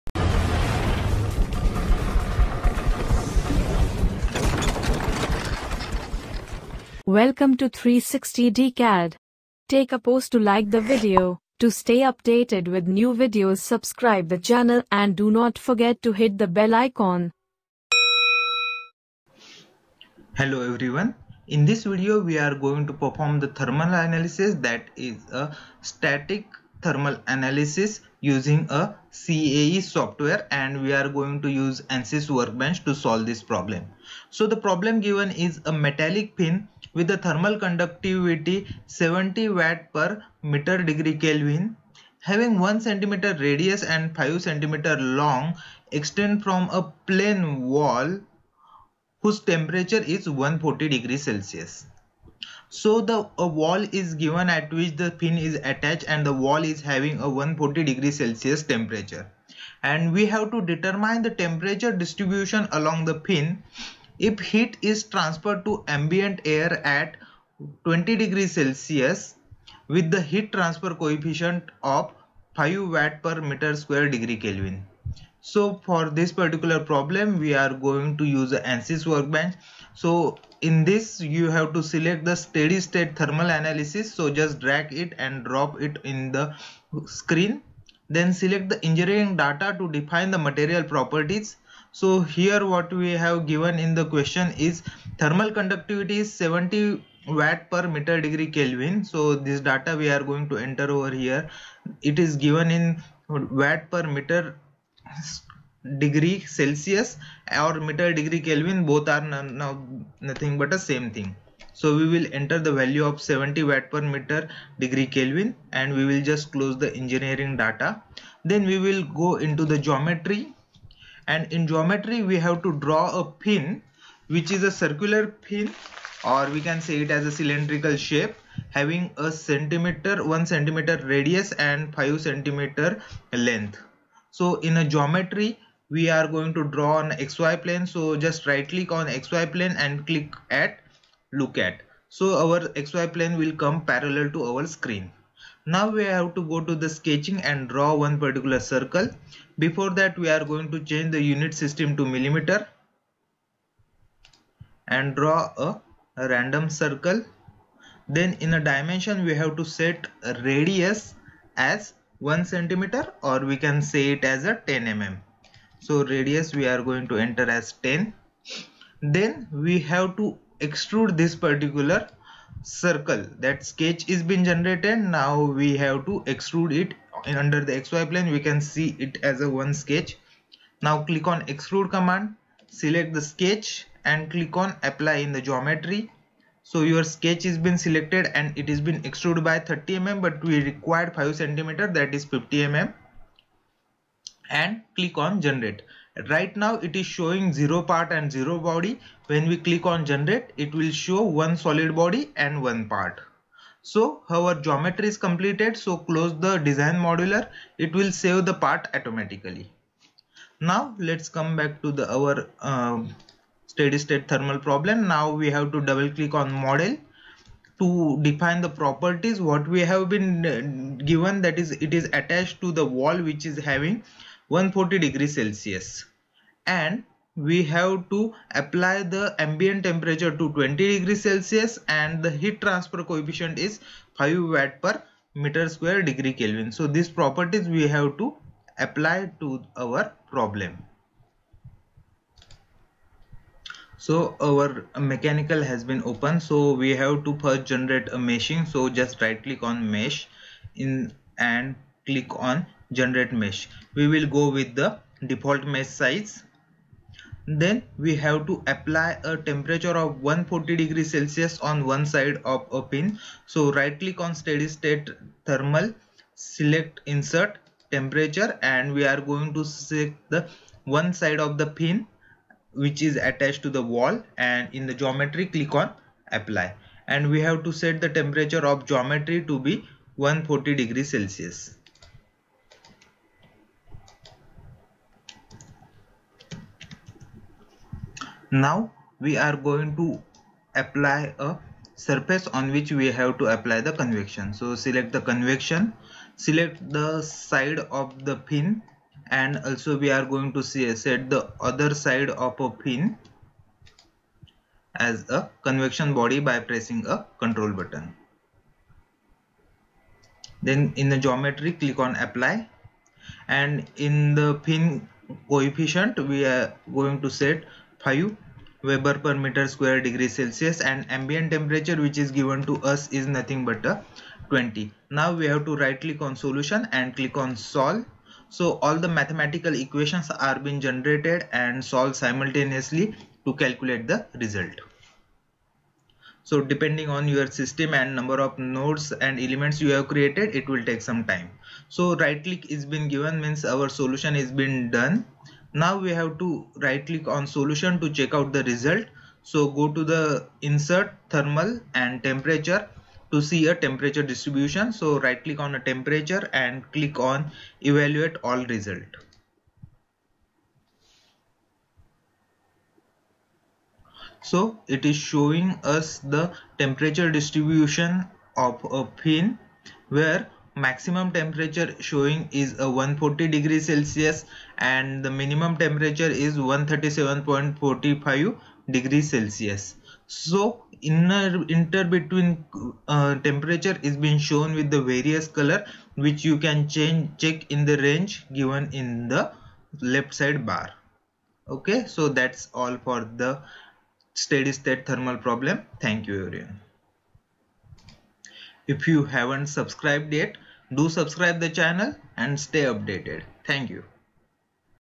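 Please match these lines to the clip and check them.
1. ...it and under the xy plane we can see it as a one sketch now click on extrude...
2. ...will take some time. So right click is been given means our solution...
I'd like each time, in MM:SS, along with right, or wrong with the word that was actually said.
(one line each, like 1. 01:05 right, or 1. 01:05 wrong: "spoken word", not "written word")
1. 02:56 right
2. 05:40 right.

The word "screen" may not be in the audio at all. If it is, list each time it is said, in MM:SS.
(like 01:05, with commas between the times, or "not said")
01:27, 02:24.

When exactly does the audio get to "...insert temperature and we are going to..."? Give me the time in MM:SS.
04:27.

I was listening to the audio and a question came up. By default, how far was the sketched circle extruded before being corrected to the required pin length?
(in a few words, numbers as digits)
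30 mm.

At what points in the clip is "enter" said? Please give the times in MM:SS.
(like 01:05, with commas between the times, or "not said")
01:40, 01:52, 02:47.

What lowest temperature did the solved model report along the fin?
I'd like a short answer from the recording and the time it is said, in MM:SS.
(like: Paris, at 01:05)
137.45 degrees Celsius, at 06:16.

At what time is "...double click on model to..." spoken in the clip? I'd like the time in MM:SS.
03:35.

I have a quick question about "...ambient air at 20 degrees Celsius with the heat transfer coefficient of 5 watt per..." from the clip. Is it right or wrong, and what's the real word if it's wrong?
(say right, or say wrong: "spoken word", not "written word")
right.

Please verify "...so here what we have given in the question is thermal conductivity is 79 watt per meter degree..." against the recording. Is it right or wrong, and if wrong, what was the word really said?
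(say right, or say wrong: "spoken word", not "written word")
wrong: "70", not "79".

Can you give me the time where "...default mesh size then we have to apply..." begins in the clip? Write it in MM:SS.
04:15.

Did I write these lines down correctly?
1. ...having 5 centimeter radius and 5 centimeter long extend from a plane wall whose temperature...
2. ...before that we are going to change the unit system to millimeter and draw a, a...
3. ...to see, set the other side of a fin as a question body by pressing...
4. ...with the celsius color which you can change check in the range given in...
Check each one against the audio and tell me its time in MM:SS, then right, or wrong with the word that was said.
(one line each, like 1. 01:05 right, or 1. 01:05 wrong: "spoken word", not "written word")
1. 00:42 wrong: "1", not "5"
2. 02:29 right
3. 05:00 wrong: "convection", not "question"
4. 06:24 wrong: "various", not "celsius".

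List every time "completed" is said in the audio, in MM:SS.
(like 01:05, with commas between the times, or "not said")
03:25.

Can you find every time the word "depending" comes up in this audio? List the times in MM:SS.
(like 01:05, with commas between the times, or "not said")
05:36.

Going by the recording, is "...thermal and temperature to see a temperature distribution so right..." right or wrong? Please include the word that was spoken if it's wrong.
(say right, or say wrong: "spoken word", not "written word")
right.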